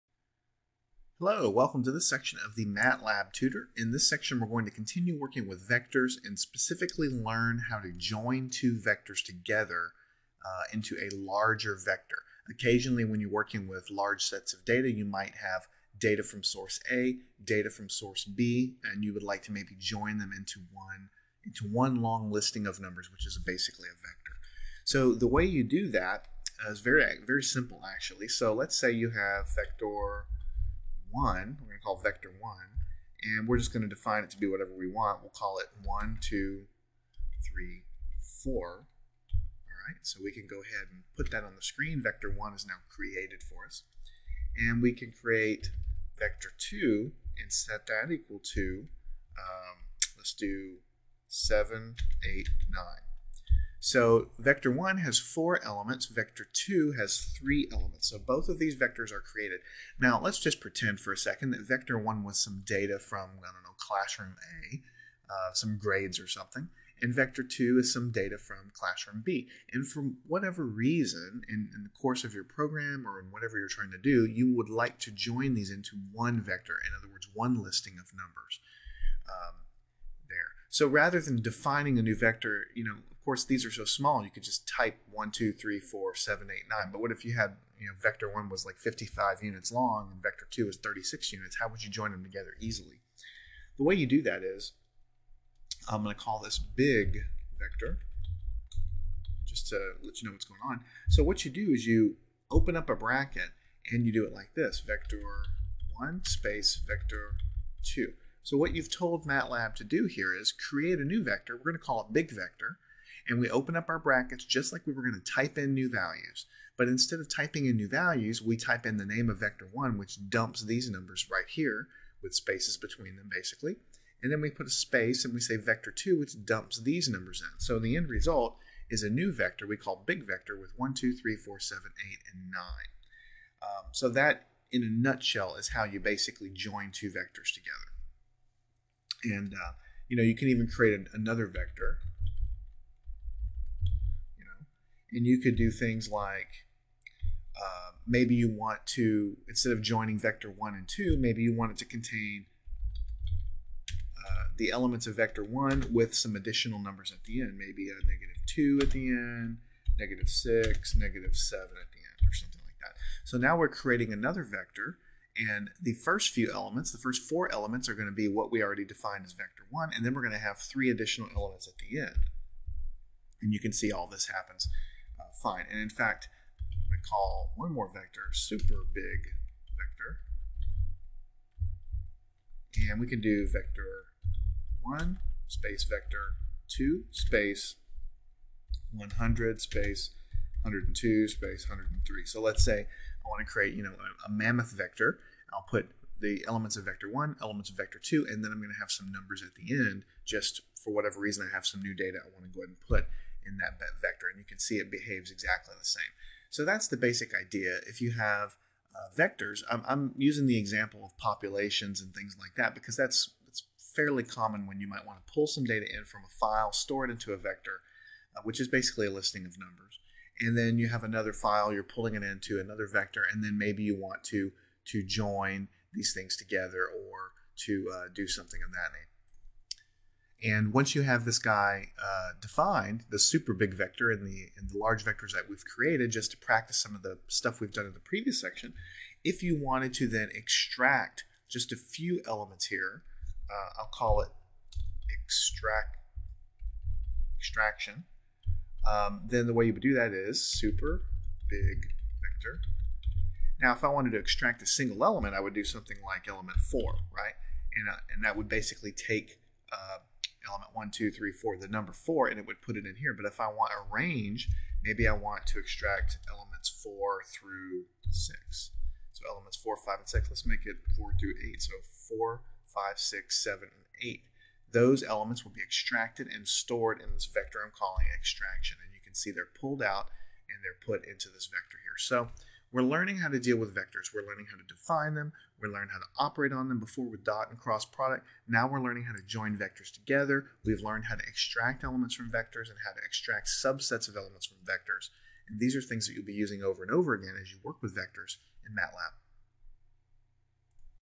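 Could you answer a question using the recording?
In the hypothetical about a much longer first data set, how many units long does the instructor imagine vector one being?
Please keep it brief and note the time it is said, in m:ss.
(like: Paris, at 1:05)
55, at 1:28.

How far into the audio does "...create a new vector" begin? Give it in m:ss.
1:50.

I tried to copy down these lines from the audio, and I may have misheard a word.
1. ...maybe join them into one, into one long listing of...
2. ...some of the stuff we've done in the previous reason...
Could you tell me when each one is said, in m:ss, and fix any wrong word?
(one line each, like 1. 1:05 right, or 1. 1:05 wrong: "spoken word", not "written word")
1. 0:19 right
2. 3:56 wrong: "section", not "reason".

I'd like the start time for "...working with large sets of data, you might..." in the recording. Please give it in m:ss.
0:13.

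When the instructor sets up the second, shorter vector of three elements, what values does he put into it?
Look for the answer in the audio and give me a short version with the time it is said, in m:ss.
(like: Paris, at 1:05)
7, 8, 9, at 0:51.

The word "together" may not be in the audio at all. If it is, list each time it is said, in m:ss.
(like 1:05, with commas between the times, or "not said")
0:09, 1:32, 2:17, 3:46, 4:49.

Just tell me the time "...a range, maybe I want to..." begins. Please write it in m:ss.
4:23.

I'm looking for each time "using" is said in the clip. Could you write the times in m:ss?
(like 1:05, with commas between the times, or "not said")
3:30, 4:56.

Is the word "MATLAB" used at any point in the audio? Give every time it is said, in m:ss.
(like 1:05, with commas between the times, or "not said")
0:02, 1:49, 4:58.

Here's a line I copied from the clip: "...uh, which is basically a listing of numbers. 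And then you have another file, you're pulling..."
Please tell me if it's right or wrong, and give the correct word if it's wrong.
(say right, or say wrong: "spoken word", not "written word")
right.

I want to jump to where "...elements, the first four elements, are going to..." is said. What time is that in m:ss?
2:46.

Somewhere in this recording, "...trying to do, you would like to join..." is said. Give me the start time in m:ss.
1:13.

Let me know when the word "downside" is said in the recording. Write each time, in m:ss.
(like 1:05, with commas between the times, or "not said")
not said.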